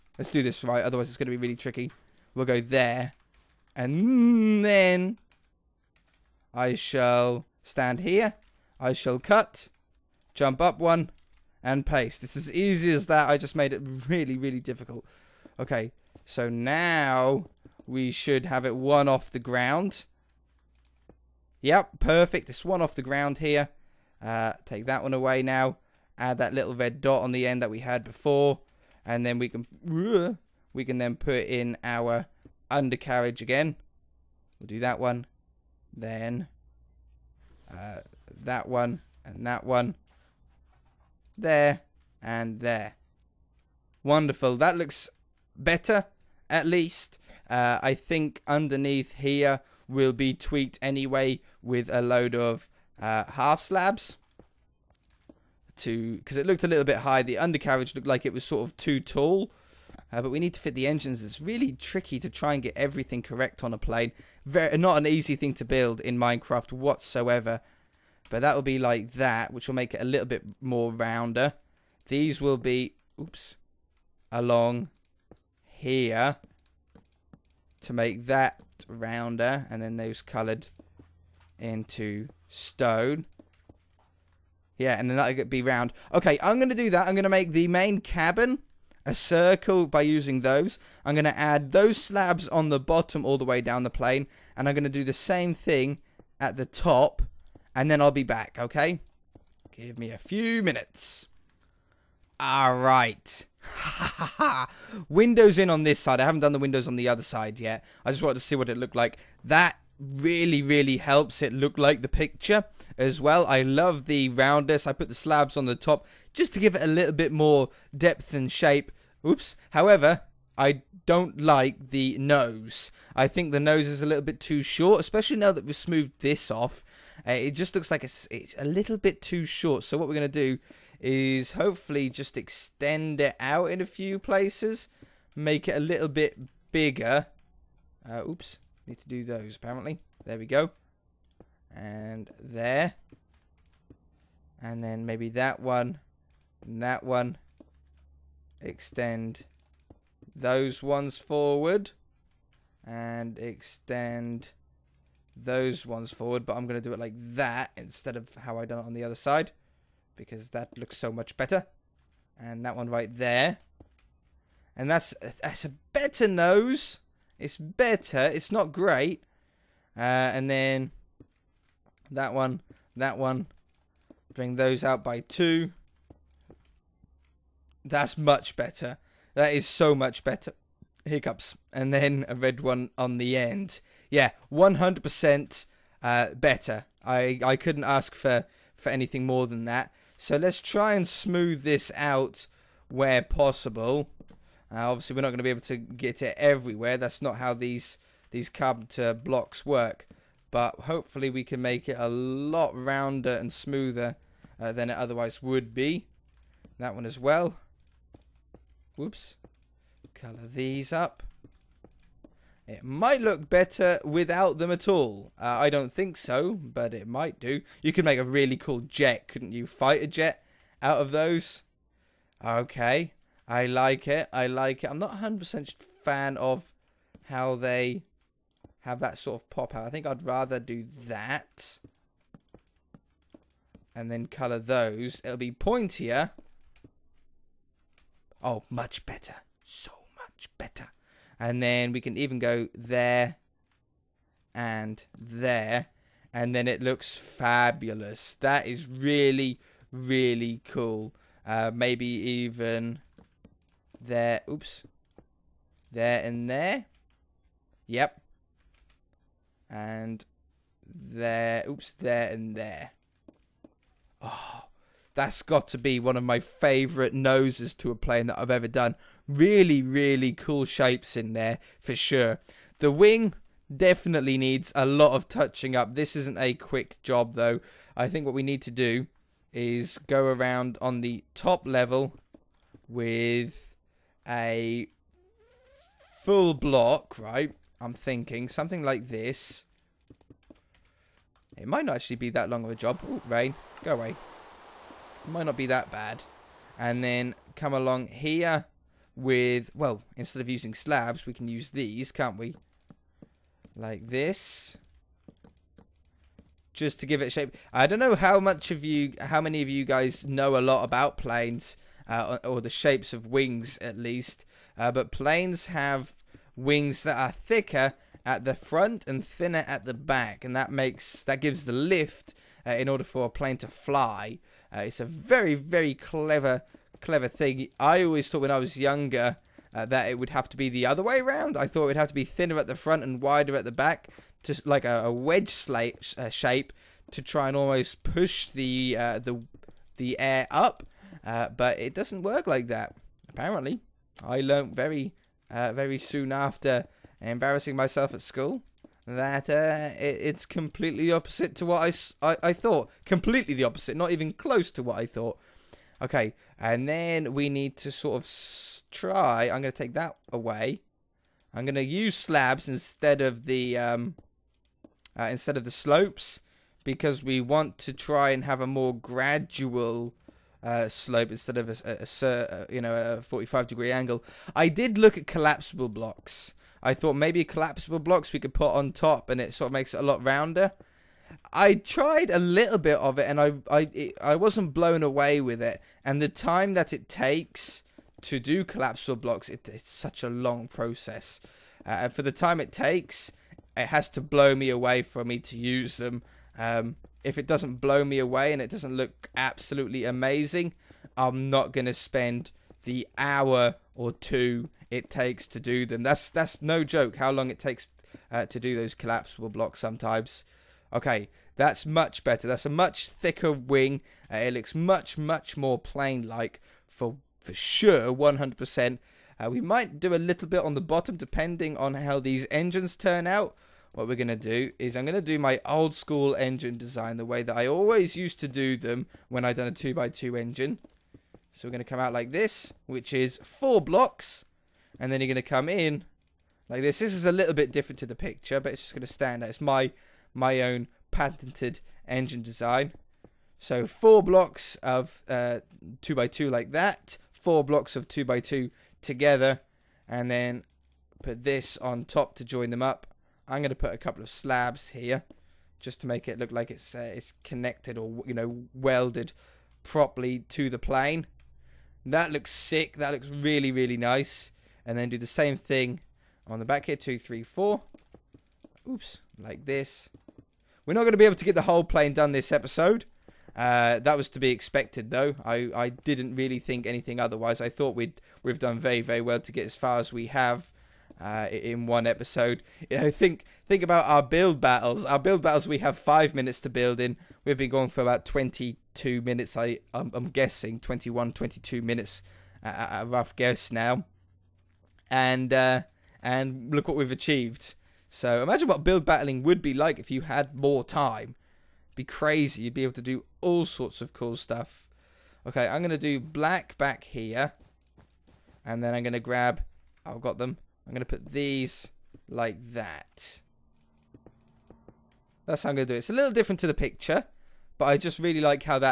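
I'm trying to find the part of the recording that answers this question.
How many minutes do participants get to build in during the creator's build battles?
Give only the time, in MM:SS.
08:05.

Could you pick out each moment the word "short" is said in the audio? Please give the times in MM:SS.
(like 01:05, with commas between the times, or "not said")
02:04, 02:09.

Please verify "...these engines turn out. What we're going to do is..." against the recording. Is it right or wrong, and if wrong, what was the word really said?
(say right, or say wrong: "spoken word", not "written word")
right.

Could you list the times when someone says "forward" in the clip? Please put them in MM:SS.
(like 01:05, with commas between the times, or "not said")
02:31, 02:36.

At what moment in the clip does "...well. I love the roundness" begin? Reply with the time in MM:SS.
01:53.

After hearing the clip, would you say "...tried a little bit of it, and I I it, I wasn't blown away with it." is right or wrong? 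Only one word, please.
right.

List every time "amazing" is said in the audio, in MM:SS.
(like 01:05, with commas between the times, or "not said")
06:40.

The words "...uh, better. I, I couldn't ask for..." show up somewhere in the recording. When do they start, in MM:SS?
03:06.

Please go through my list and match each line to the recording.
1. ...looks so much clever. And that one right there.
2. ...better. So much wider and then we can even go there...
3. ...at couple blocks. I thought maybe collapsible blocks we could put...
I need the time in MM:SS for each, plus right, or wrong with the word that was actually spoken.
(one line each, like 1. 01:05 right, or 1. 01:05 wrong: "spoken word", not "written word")
1. 02:40 wrong: "better", not "clever"
2. 03:59 wrong: "better", not "wider"
3. 06:15 wrong: "collapsible", not "couple".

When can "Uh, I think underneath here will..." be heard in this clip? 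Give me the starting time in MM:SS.
00:47.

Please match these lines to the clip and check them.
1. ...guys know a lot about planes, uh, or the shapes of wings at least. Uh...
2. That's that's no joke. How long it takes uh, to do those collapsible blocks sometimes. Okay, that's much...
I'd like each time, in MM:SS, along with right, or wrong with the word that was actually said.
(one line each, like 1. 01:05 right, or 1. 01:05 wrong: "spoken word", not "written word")
1. 05:09 right
2. 06:46 right.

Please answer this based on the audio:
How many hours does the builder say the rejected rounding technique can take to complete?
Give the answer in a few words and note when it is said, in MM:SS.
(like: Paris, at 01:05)
1 or 2, at 06:42.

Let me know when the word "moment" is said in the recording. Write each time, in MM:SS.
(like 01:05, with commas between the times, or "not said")
not said.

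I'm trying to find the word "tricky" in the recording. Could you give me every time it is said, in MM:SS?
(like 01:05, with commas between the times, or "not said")
00:01, 01:01.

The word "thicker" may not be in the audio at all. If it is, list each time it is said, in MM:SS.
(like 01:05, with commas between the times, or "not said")
05:17, 06:53.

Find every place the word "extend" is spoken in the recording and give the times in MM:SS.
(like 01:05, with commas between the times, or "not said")
02:12, 02:28, 02:33.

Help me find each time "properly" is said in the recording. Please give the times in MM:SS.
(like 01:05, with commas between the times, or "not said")
07:39.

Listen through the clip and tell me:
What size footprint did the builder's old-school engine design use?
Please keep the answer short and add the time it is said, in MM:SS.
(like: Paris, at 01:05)
2x2, at 07:09.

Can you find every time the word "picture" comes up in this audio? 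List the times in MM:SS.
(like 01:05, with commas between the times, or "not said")
01:52, 07:18, 08:36.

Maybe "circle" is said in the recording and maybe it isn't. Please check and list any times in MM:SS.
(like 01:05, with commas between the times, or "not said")
01:29.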